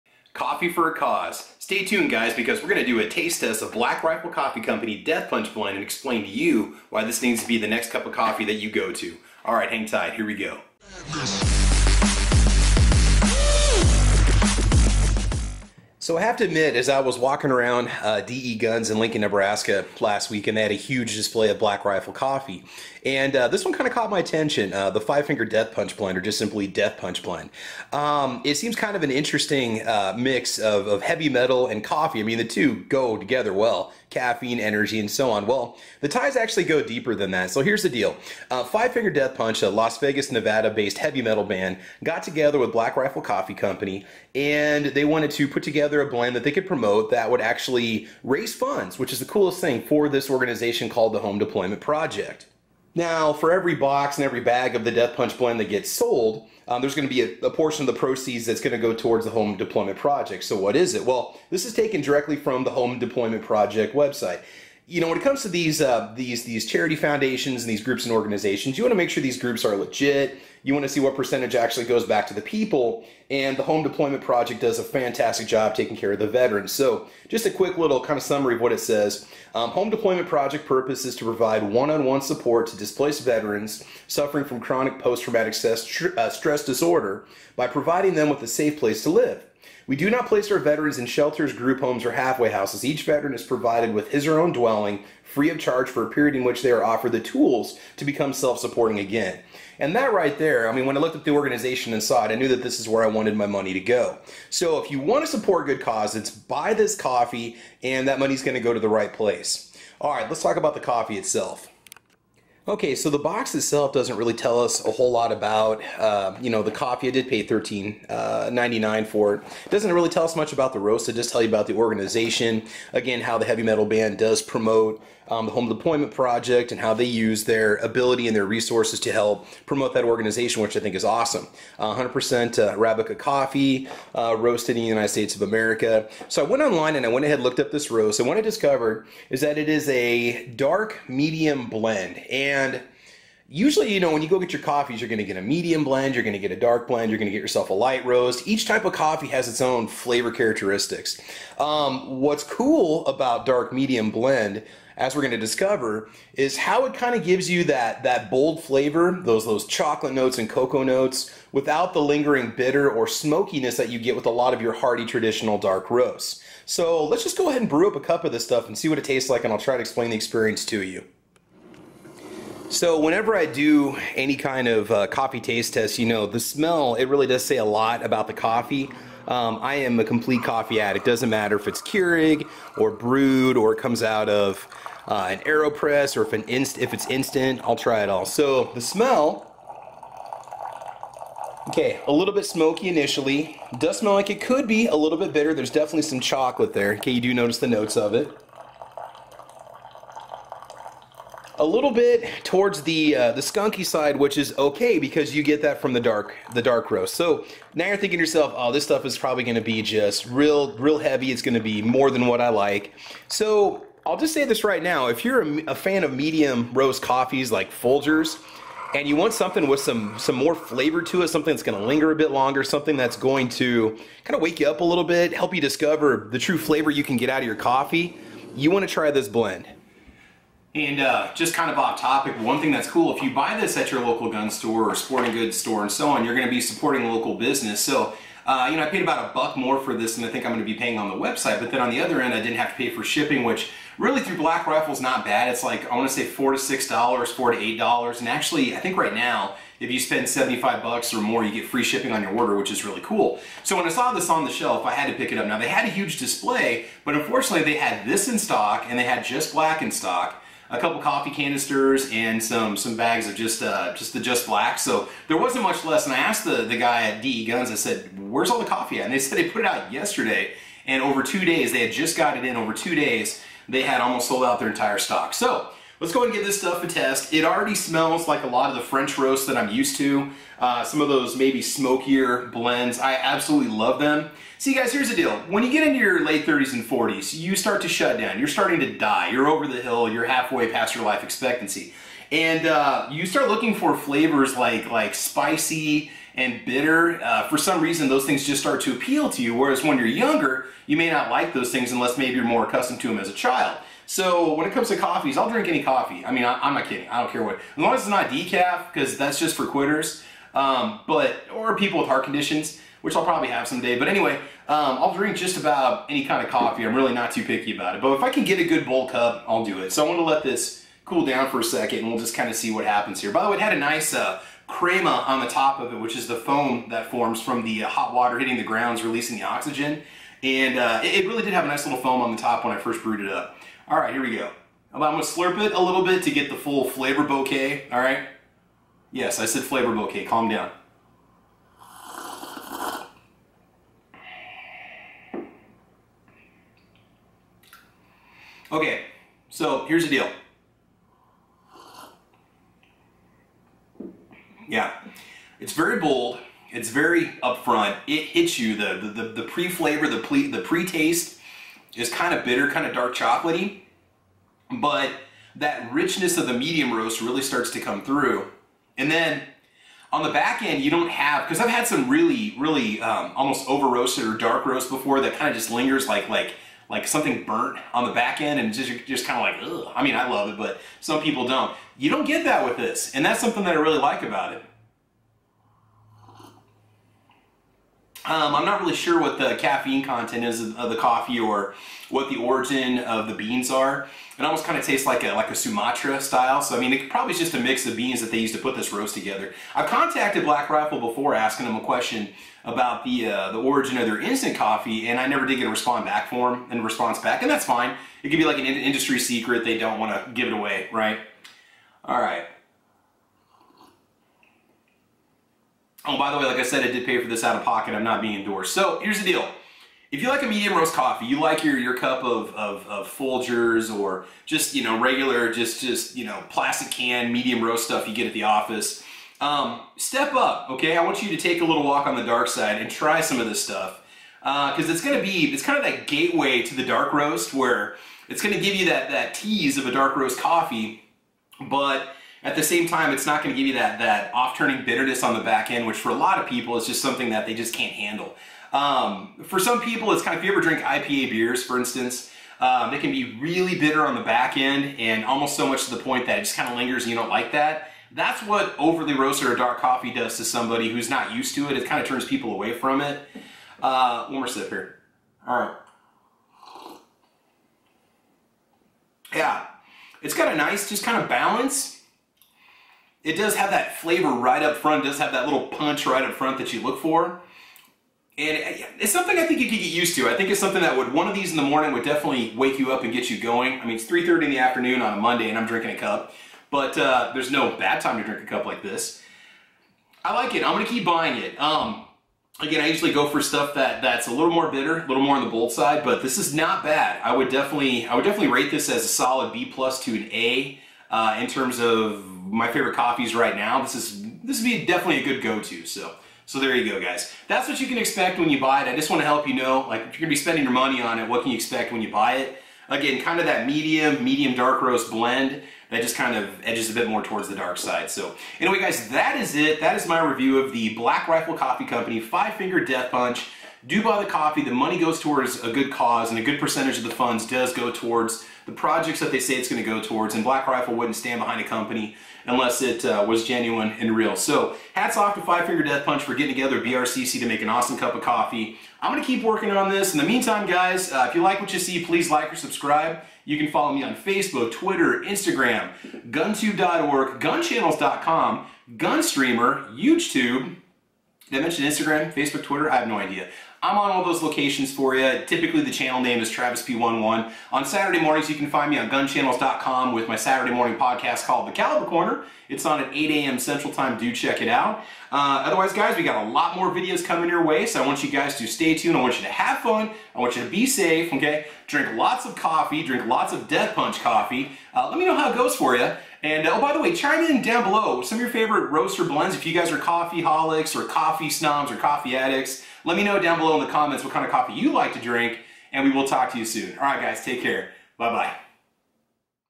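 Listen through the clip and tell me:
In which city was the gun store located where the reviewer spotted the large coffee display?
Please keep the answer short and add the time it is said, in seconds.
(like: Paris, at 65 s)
Lincoln, Nebraska, at 18 s.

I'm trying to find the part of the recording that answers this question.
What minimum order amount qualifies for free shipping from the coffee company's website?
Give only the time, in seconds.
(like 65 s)
250 s.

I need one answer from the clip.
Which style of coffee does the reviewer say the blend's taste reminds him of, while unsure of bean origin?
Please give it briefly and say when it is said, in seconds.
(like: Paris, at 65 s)
Sumatra, at 395 s.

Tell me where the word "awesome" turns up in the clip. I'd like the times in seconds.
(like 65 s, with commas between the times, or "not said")
131 s, 537 s.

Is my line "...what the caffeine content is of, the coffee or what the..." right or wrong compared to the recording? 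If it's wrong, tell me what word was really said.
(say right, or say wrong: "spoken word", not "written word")
right.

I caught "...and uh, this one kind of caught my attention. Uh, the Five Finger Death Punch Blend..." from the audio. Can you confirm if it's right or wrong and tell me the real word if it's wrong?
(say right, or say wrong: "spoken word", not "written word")
right.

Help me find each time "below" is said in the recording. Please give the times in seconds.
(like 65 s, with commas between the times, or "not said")
577 s, 583 s.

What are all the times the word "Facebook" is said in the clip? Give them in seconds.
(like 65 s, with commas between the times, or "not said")
544 s, 552 s.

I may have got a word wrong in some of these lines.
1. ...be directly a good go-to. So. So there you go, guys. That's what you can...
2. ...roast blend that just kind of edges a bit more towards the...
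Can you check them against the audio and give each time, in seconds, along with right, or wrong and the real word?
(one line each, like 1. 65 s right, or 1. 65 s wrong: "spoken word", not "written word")
1. 504 s wrong: "definitely", not "directly"
2. 514 s right.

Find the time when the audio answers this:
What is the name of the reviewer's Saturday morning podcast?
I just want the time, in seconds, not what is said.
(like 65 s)
561 s.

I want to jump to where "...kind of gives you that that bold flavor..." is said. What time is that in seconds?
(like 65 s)
156 s.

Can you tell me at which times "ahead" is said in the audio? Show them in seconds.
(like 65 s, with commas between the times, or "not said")
137 s, 167 s, 276 s.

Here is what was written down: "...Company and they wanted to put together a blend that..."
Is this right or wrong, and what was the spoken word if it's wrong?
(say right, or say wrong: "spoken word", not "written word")
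right.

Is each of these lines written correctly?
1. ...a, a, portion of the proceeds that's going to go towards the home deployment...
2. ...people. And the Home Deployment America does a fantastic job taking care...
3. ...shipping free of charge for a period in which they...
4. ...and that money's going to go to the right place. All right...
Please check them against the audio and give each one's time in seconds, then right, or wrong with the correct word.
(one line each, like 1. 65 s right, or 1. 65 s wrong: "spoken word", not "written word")
1. 57 s right
2. 72 s wrong: "Project", not "America"
3. 94 s wrong: "dwelling", not "shipping"
4. 107 s right.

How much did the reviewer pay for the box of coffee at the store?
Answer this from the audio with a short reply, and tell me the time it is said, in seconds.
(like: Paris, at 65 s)
$13.99, at 117 s.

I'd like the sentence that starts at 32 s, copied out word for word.
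I mean, the two go together well caffeine, energy, and so on.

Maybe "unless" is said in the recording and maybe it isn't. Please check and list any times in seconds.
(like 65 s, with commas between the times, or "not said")
301 s, 532 s.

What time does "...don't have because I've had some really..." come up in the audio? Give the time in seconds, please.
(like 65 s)
370 s.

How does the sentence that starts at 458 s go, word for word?
That's what overly roasted or dark coffee does to somebody who's not used to it.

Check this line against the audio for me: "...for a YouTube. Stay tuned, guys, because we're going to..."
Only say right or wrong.
wrong.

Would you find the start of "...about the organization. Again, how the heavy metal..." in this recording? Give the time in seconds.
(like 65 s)
121 s.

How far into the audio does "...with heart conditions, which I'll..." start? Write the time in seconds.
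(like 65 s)
311 s.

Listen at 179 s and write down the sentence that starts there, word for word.
Um, I am a complete coffee addict.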